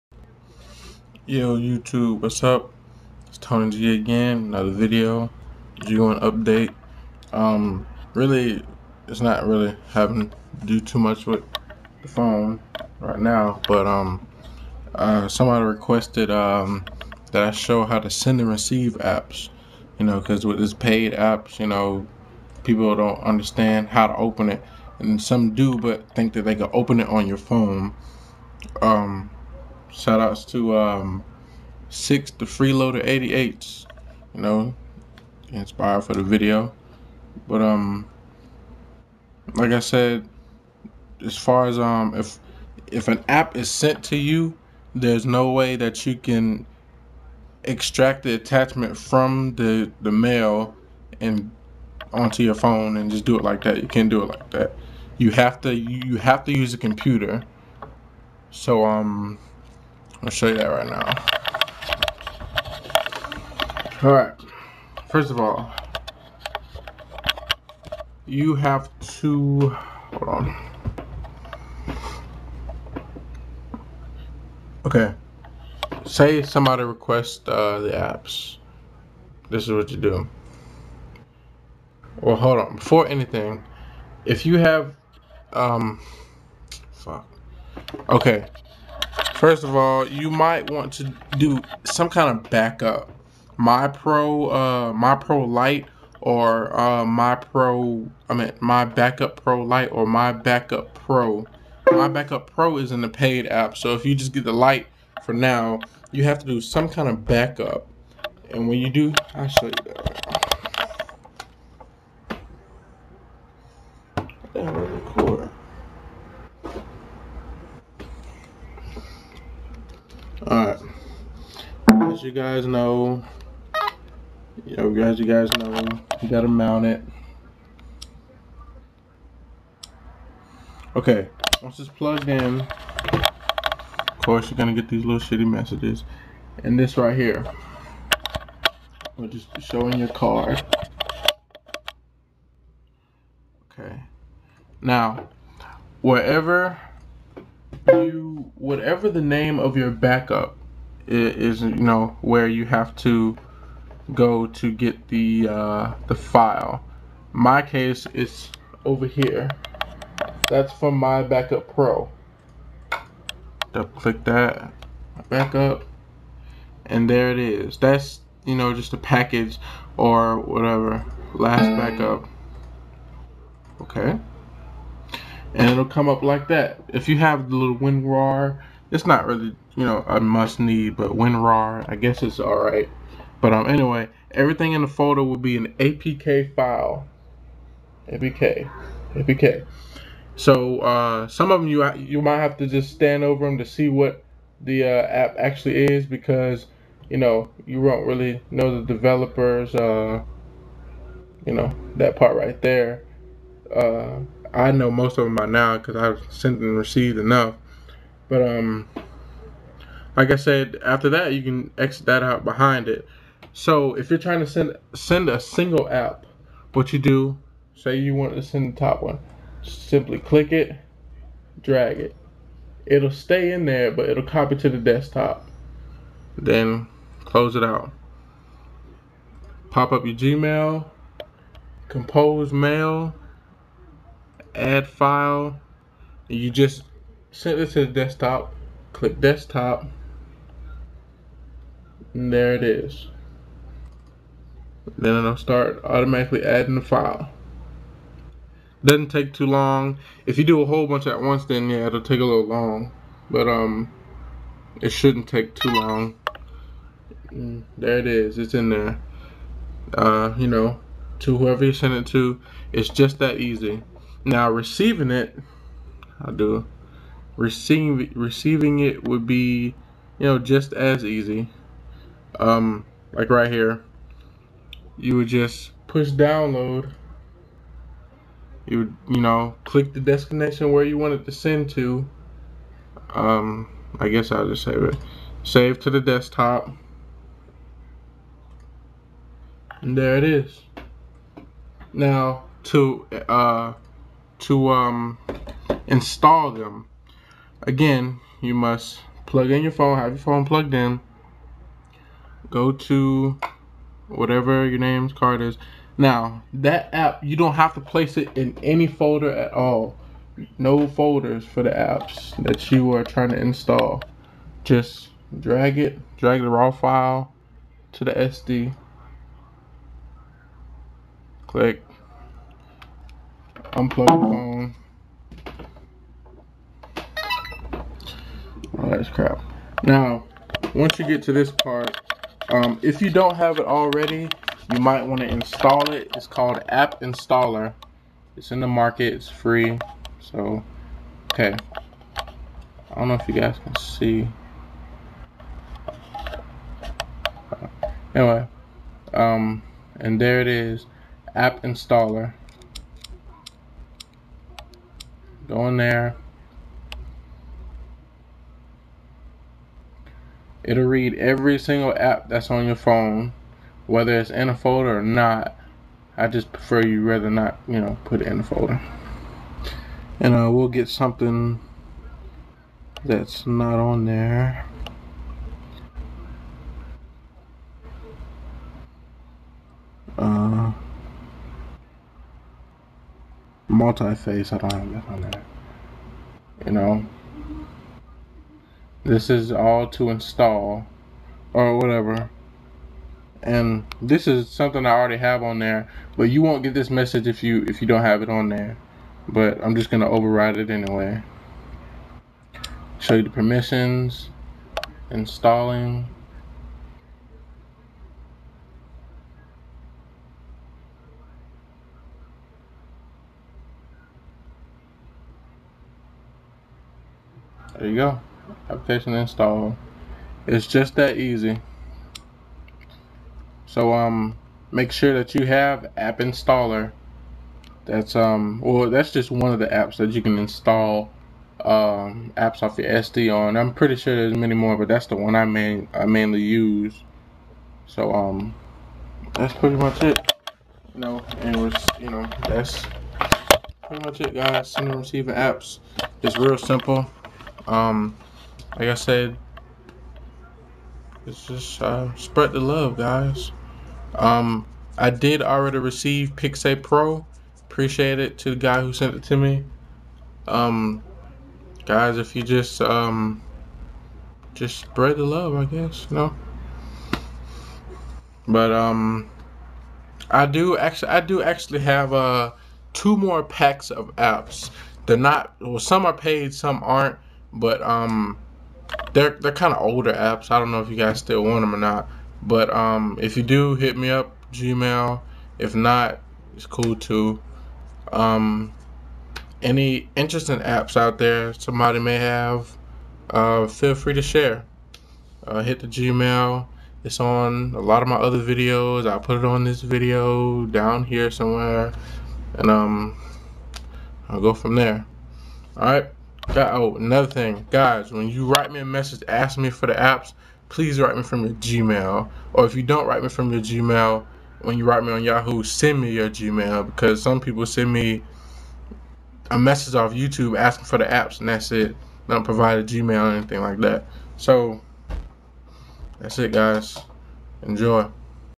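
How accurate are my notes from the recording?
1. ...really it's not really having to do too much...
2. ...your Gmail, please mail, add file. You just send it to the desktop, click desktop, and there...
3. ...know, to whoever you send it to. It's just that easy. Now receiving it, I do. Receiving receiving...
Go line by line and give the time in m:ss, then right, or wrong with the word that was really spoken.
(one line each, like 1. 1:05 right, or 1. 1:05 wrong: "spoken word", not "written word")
1. 0:08 right
2. 3:50 wrong: "compose", not "please"
3. 4:20 right.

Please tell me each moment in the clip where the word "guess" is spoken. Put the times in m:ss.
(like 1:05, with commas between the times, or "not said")
3:01, 4:44, 7:45.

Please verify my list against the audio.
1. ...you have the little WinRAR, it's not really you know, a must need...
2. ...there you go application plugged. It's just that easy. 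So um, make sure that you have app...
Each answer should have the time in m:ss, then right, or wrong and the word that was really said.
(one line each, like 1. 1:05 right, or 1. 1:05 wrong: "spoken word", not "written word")
1. 2:57 right
2. 6:57 wrong: "installed", not "plugged".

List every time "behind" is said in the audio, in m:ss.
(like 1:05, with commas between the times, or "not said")
3:32.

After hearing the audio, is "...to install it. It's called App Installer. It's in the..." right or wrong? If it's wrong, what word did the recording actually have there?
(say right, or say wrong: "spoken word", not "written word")
right.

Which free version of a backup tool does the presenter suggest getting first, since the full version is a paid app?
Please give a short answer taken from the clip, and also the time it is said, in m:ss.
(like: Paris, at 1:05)
My Backup Pro Light, at 1:38.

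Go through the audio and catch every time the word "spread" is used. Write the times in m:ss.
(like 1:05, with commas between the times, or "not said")
7:32, 7:44.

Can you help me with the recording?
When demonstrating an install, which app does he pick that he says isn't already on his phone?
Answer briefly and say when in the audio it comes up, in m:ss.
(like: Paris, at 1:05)
multi-face, at 6:23.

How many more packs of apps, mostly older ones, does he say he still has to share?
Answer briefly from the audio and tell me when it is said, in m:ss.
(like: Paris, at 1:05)
2, at 7:52.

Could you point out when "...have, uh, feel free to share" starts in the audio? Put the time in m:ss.
8:12.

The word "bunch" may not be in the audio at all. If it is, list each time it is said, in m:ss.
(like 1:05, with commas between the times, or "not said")
4:10.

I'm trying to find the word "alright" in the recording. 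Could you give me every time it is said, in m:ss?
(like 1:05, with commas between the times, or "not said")
1:04, 3:02.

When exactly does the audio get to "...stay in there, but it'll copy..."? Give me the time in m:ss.
3:43.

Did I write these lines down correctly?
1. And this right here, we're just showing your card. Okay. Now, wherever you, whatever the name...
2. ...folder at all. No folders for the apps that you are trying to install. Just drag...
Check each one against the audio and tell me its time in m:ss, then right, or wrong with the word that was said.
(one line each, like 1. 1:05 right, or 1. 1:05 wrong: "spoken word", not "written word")
1. 2:16 right
2. 5:08 right.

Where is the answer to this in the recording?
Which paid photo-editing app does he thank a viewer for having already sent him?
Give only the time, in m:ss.
7:36.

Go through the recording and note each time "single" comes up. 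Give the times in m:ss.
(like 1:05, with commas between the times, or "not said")
3:35, 6:01.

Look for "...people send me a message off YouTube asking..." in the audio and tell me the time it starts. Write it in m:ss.
8:37.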